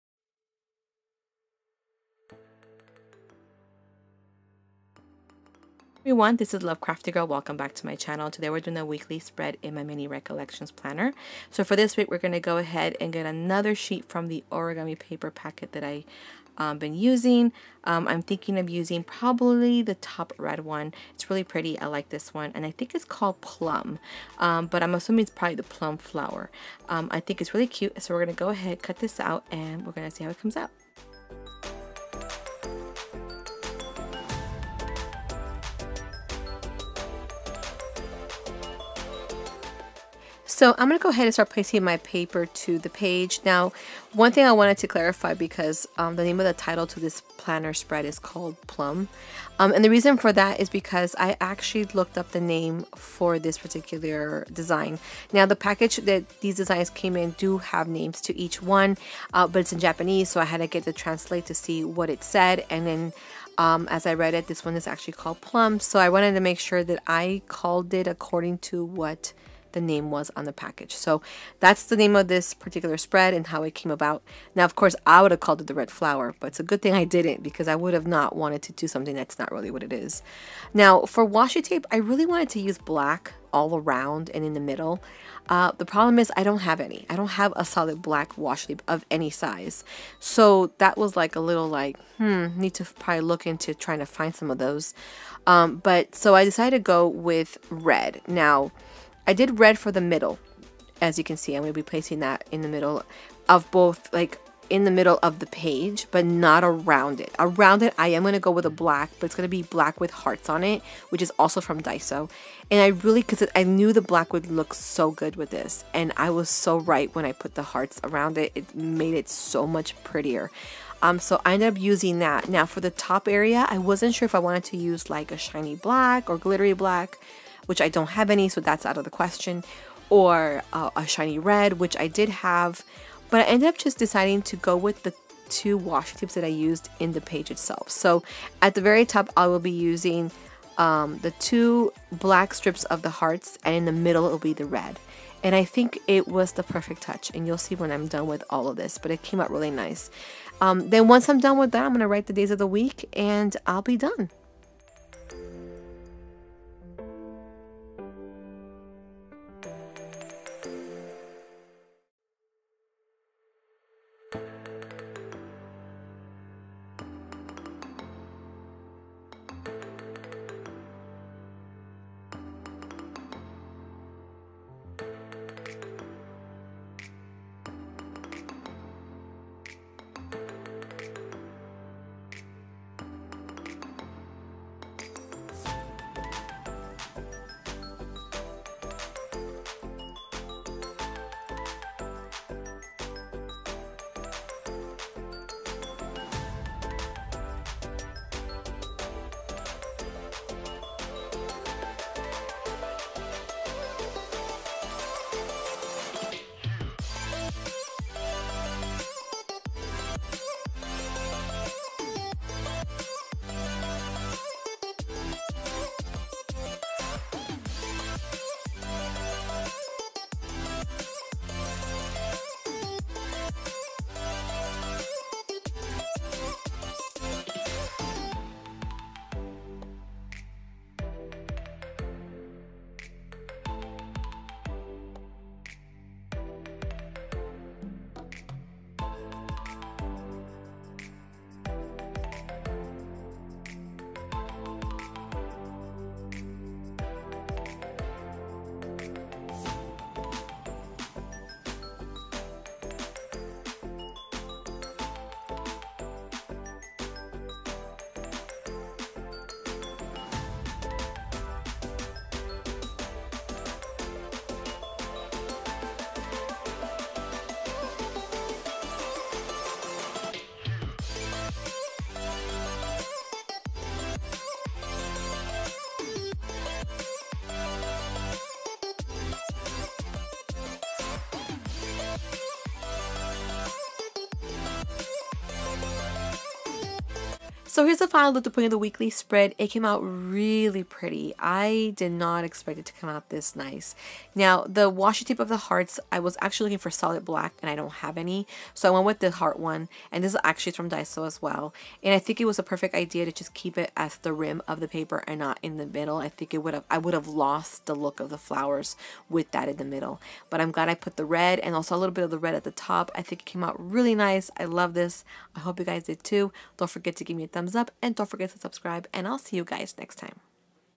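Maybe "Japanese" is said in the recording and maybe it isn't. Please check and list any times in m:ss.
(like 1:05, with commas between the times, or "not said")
0:59.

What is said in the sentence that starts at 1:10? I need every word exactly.
So that's the name of this particular spread and how it came about.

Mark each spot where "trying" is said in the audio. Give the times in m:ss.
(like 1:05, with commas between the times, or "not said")
1:33.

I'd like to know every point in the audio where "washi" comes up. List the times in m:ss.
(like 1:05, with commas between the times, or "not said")
1:21, 1:28, 2:15, 4:54.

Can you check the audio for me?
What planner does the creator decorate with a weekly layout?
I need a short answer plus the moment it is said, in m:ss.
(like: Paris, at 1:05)
mini recollections planner, at 0:09.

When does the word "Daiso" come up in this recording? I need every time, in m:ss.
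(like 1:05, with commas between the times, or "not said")
1:51, 5:00.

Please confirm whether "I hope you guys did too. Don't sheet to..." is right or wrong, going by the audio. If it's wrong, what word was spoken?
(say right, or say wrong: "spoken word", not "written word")
wrong: "forget", not "sheet".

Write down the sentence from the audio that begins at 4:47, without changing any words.
So here's the final look to put in the weekly spread.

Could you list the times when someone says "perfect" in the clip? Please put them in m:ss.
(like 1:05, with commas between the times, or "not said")
2:26, 5:02.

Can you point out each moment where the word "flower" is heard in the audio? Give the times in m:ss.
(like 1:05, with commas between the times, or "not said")
0:25, 1:15, 5:08.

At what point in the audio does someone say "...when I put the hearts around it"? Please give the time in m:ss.
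1:57.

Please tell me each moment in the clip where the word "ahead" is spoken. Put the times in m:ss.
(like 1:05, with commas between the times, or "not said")
0:12, 0:28, 0:41.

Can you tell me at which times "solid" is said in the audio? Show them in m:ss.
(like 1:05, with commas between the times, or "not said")
1:27, 4:56.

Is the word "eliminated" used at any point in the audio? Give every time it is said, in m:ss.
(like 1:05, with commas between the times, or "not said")
not said.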